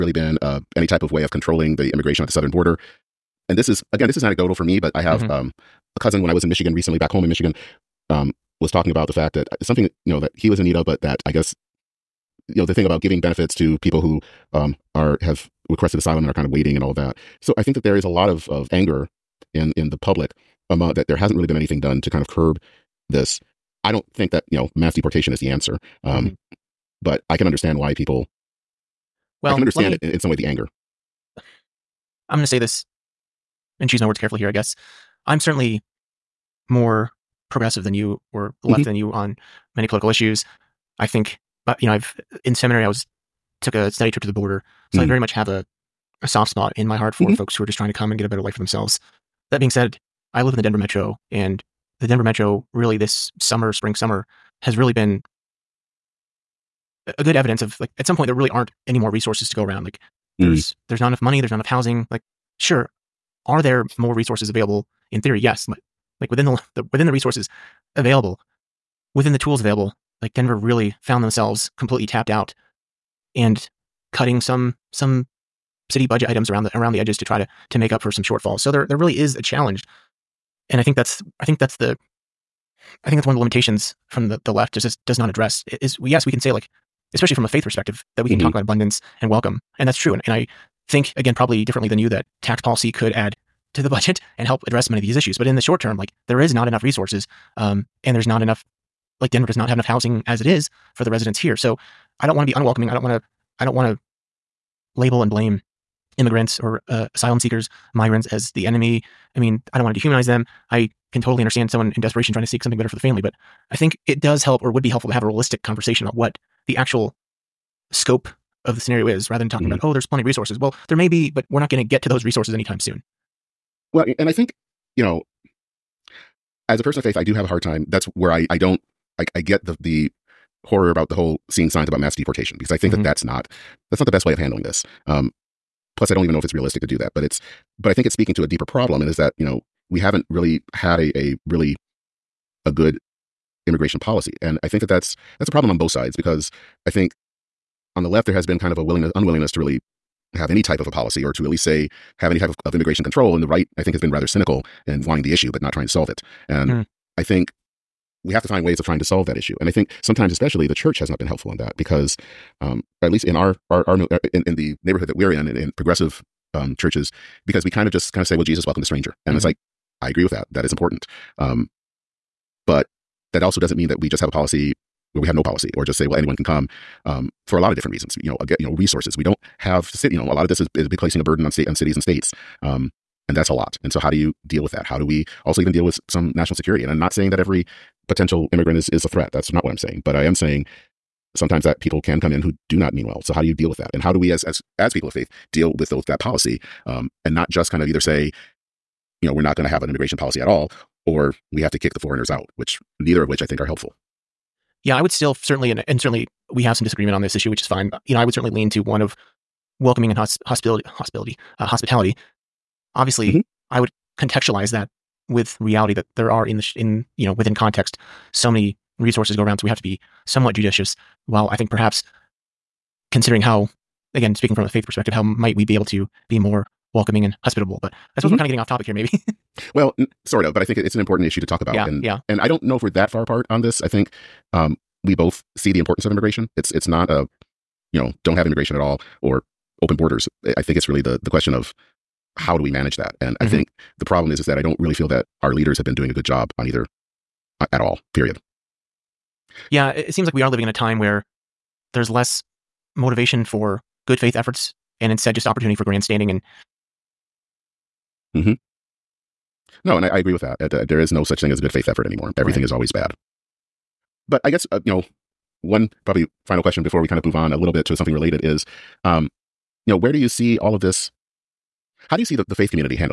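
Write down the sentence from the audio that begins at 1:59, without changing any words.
about, oh, there's plenty of resources.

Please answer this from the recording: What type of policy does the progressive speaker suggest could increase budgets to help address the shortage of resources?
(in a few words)
Tax policy.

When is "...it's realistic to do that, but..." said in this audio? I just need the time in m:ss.
2:16.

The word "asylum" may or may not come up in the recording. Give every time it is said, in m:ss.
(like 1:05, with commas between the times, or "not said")
0:15, 1:47.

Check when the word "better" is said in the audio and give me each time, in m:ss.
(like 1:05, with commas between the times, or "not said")
0:48, 1:52.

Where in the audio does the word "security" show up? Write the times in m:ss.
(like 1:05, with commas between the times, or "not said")
3:06.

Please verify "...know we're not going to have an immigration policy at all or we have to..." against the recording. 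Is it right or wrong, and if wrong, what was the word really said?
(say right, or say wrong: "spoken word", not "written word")
right.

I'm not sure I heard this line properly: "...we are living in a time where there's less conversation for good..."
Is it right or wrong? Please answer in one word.
wrong.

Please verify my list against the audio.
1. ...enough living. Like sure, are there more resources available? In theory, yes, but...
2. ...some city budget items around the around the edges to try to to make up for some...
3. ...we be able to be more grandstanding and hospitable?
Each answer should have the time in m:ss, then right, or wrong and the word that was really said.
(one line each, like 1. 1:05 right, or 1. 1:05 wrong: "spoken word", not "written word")
1. 1:01 wrong: "housing", not "living"
2. 1:14 right
3. 3:45 wrong: "welcoming", not "grandstanding".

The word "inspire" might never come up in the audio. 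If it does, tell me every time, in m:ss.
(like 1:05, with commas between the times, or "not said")
not said.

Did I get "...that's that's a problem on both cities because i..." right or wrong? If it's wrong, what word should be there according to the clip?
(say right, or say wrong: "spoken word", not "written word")
wrong: "sides", not "cities".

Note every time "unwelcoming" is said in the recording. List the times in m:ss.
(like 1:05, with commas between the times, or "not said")
1:42.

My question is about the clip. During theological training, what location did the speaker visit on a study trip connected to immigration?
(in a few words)
The border.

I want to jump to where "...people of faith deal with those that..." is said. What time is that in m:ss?
3:14.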